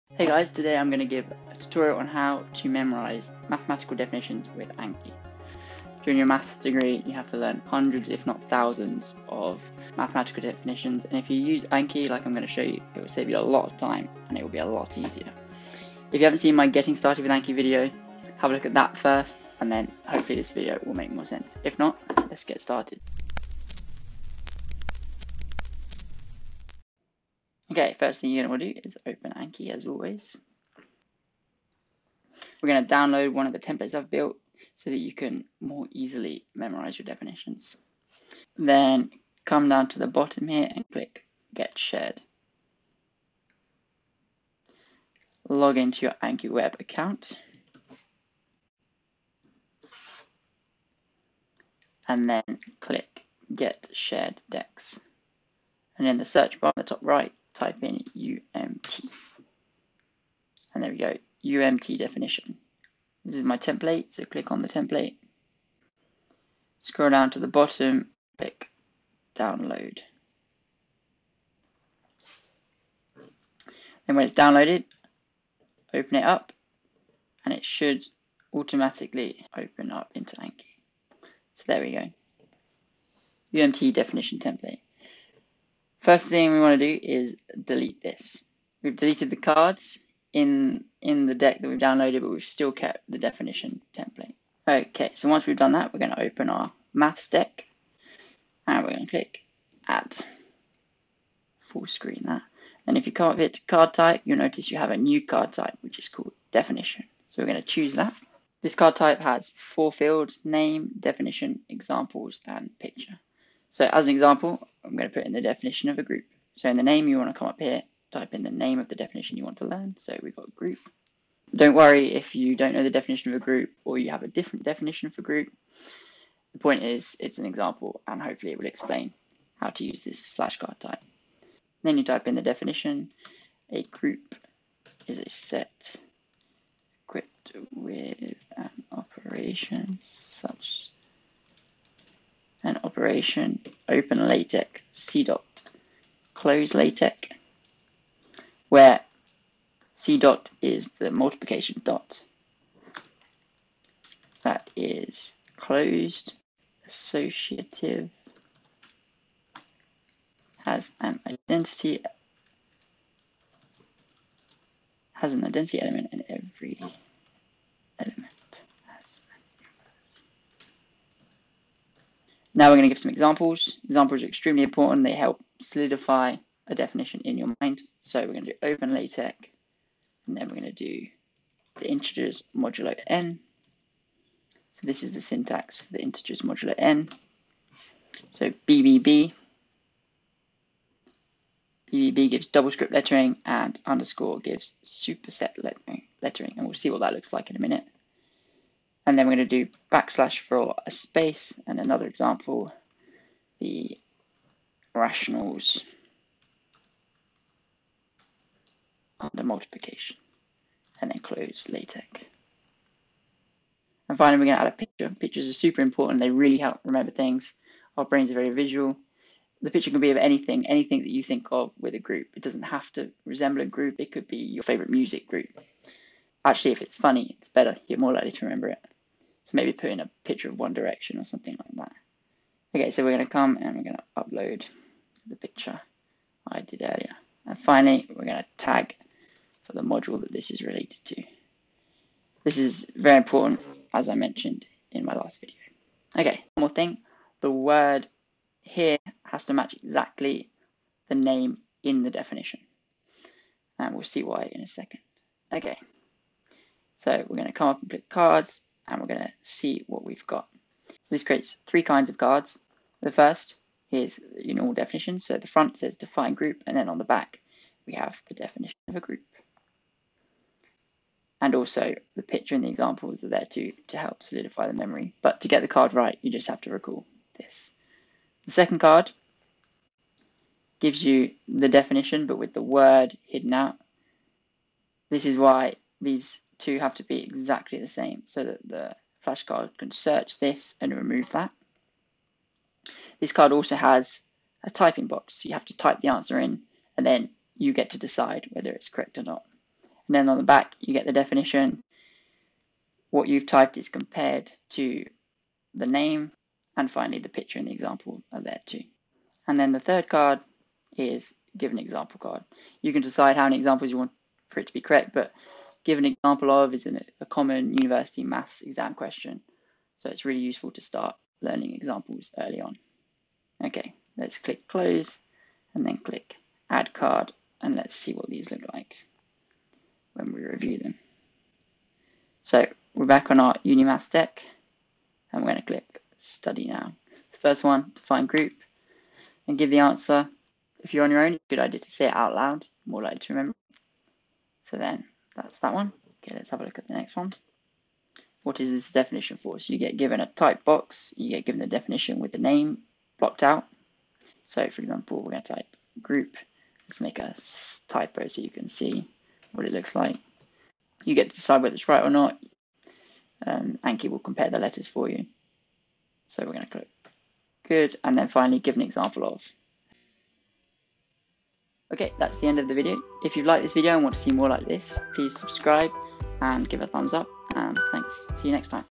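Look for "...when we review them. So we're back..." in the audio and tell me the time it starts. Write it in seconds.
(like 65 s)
330 s.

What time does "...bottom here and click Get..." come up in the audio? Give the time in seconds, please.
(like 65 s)
40 s.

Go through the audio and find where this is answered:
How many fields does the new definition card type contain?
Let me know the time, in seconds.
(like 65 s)
109 s.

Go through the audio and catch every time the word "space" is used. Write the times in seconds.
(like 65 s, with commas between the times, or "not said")
200 s.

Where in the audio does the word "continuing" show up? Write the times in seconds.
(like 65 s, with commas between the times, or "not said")
not said.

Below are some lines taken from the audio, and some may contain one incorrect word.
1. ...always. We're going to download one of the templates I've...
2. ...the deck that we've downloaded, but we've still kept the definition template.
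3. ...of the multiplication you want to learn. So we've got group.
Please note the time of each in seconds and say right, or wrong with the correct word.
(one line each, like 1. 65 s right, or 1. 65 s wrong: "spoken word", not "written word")
1. 29 s right
2. 91 s right
3. 118 s wrong: "definition", not "multiplication".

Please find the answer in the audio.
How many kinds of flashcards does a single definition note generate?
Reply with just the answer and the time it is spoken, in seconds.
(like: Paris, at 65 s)
3, at 261 s.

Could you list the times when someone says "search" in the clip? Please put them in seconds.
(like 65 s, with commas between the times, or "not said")
56 s, 289 s.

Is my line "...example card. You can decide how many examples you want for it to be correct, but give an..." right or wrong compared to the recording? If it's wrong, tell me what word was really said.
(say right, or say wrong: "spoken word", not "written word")
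right.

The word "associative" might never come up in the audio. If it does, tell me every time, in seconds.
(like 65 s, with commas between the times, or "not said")
156 s.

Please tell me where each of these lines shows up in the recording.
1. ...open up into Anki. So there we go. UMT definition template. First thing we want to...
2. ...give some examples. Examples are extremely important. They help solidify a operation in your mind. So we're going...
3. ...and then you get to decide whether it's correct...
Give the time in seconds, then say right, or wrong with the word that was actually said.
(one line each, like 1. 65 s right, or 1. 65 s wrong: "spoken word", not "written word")
1. 79 s right
2. 172 s wrong: "definition", not "operation"
3. 296 s right.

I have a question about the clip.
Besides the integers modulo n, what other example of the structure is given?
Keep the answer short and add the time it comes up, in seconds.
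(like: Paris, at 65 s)
The rationals under multiplication, at 203 s.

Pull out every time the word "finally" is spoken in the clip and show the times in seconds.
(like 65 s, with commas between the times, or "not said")
214 s, 237 s, 306 s, 368 s.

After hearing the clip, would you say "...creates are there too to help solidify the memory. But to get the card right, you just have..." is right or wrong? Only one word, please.
wrong.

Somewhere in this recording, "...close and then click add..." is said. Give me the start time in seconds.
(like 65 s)
324 s.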